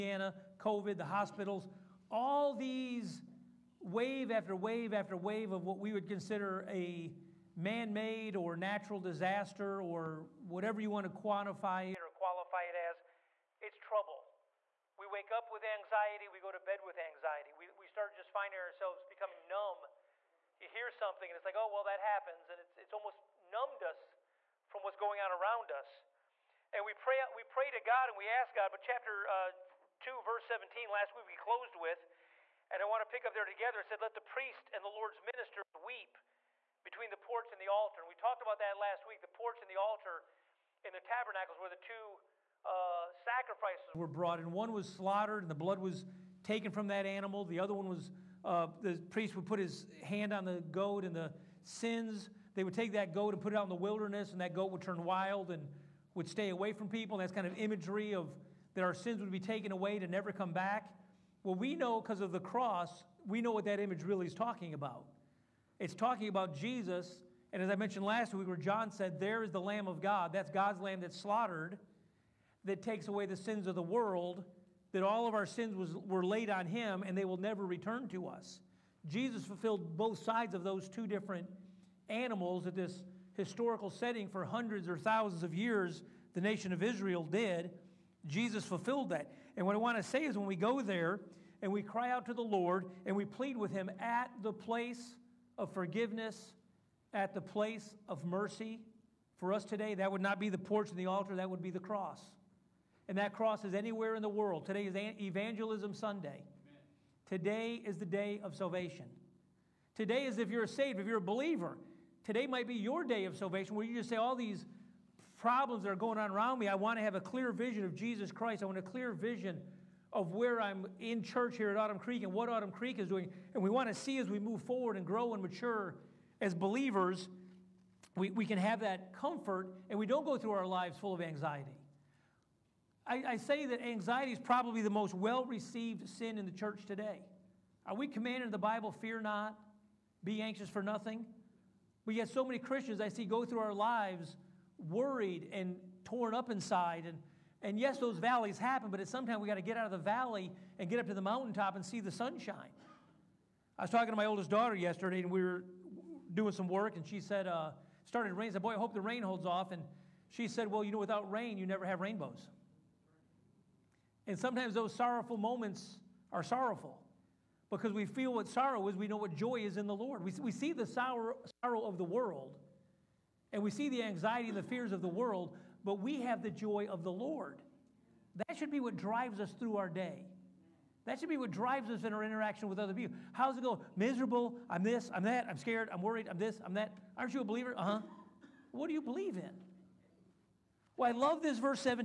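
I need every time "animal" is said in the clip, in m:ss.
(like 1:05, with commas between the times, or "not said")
0:47, 1:22.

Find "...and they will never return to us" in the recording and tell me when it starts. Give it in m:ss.
1:17.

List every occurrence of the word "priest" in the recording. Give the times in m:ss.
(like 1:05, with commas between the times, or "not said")
0:34, 0:49.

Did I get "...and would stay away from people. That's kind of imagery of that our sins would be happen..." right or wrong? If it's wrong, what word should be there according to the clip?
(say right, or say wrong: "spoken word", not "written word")
wrong: "taken", not "happen".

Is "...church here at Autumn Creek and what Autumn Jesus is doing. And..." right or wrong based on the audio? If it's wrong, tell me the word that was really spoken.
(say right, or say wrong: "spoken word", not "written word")
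wrong: "Creek", not "Jesus".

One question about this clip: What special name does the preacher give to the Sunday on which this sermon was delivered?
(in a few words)
Evangelism Sunday.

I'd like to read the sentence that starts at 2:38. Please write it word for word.
I said, Boy, I hope the rain holds off.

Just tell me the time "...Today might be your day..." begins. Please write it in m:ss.
1:52.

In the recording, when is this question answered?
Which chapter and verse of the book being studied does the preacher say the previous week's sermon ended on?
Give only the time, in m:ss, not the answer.
0:28.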